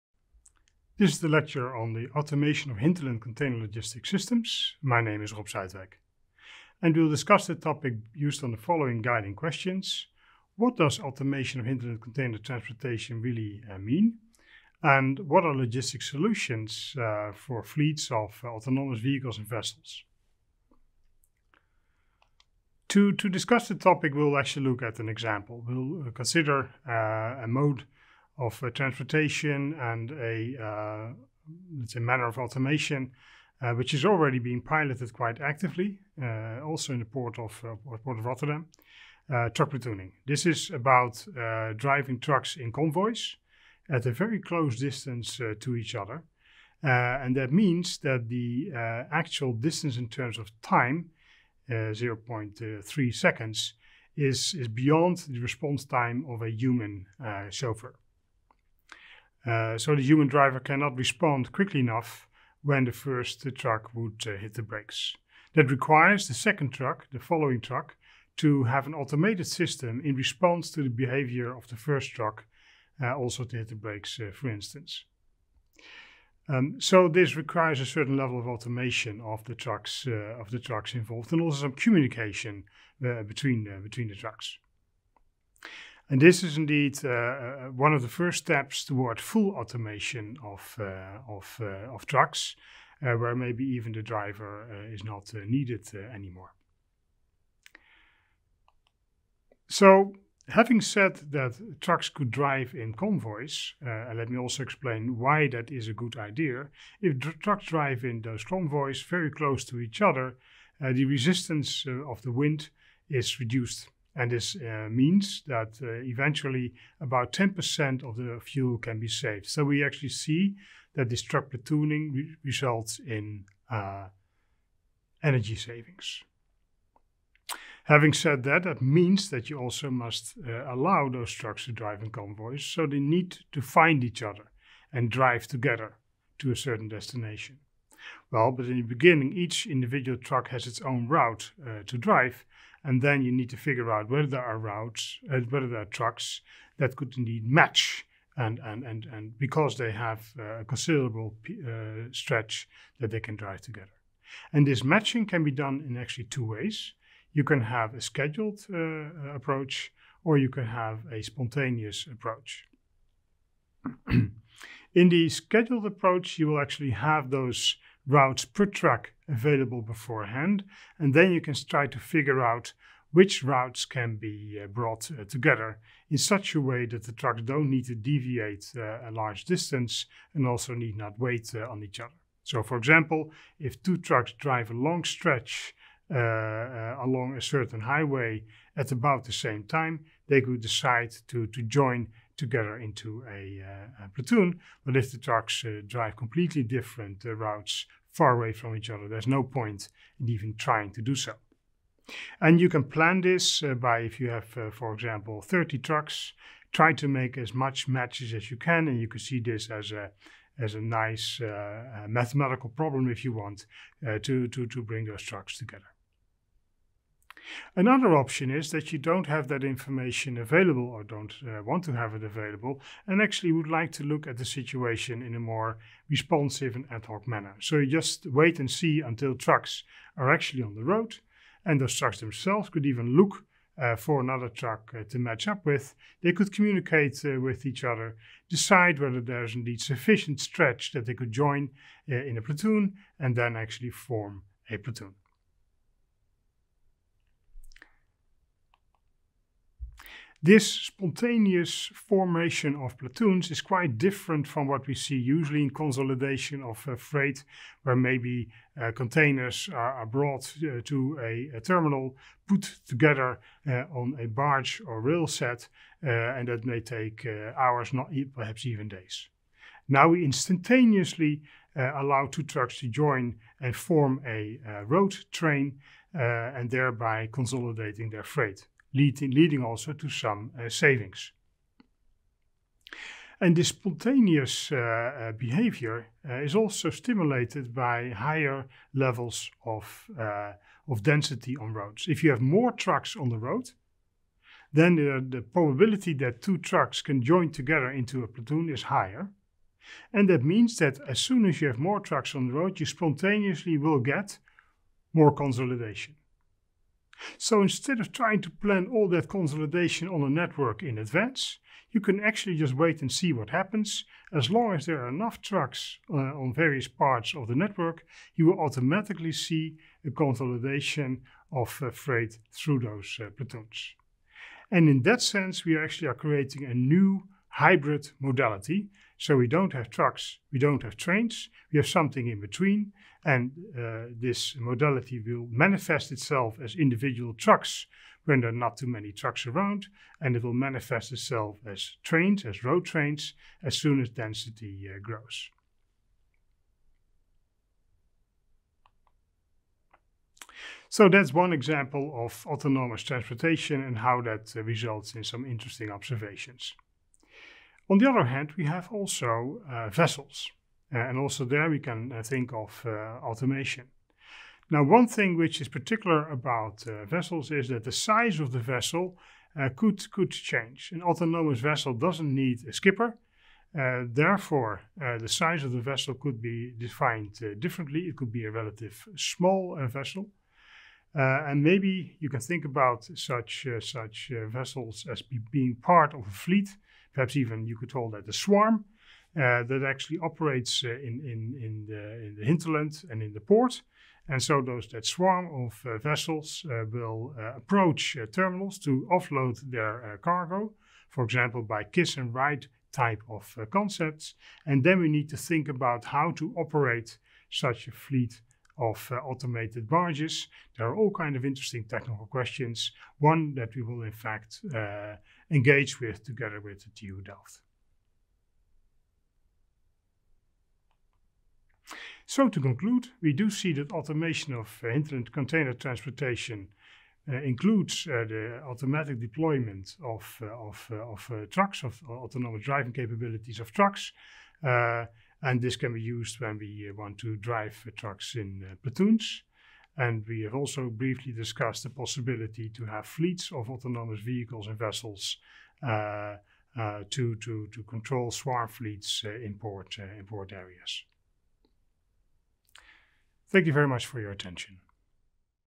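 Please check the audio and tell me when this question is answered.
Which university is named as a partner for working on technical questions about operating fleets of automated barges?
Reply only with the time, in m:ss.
6:56.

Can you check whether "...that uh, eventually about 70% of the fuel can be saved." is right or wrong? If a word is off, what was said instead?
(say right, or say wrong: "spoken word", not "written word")
wrong: "10", not "70".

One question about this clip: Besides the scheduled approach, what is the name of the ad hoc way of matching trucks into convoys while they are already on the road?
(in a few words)
spontaneous approach.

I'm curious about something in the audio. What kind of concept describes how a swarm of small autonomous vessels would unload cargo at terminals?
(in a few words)
kiss and ride.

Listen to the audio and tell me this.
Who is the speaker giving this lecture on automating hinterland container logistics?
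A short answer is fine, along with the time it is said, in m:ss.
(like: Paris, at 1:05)
Rob Zuidwijk, at 0:05.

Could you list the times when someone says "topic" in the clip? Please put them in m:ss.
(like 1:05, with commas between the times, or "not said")
0:07, 0:23.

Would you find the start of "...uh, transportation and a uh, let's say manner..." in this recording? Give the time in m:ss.
0:28.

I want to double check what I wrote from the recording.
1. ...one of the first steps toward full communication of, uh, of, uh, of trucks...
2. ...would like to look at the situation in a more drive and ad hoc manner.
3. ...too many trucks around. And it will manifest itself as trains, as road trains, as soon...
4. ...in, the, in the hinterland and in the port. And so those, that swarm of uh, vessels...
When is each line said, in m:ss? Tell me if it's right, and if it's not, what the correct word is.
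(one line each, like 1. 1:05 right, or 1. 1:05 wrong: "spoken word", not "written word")
1. 1:27 wrong: "automation", not "communication"
2. 3:43 wrong: "responsive", not "drive"
3. 5:38 right
4. 6:31 right.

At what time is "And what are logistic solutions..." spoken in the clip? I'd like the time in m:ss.
0:14.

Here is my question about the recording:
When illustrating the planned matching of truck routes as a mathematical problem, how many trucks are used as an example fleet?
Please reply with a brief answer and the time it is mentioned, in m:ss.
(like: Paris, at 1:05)
30, at 3:25.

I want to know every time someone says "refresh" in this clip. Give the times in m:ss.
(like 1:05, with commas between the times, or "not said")
not said.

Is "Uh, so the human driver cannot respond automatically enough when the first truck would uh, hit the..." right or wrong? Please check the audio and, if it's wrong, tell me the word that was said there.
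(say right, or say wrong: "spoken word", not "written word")
wrong: "quickly", not "automatically".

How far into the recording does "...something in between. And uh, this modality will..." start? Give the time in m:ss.
5:31.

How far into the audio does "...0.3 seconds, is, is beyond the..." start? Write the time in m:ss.
0:51.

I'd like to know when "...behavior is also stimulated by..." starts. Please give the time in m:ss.
4:45.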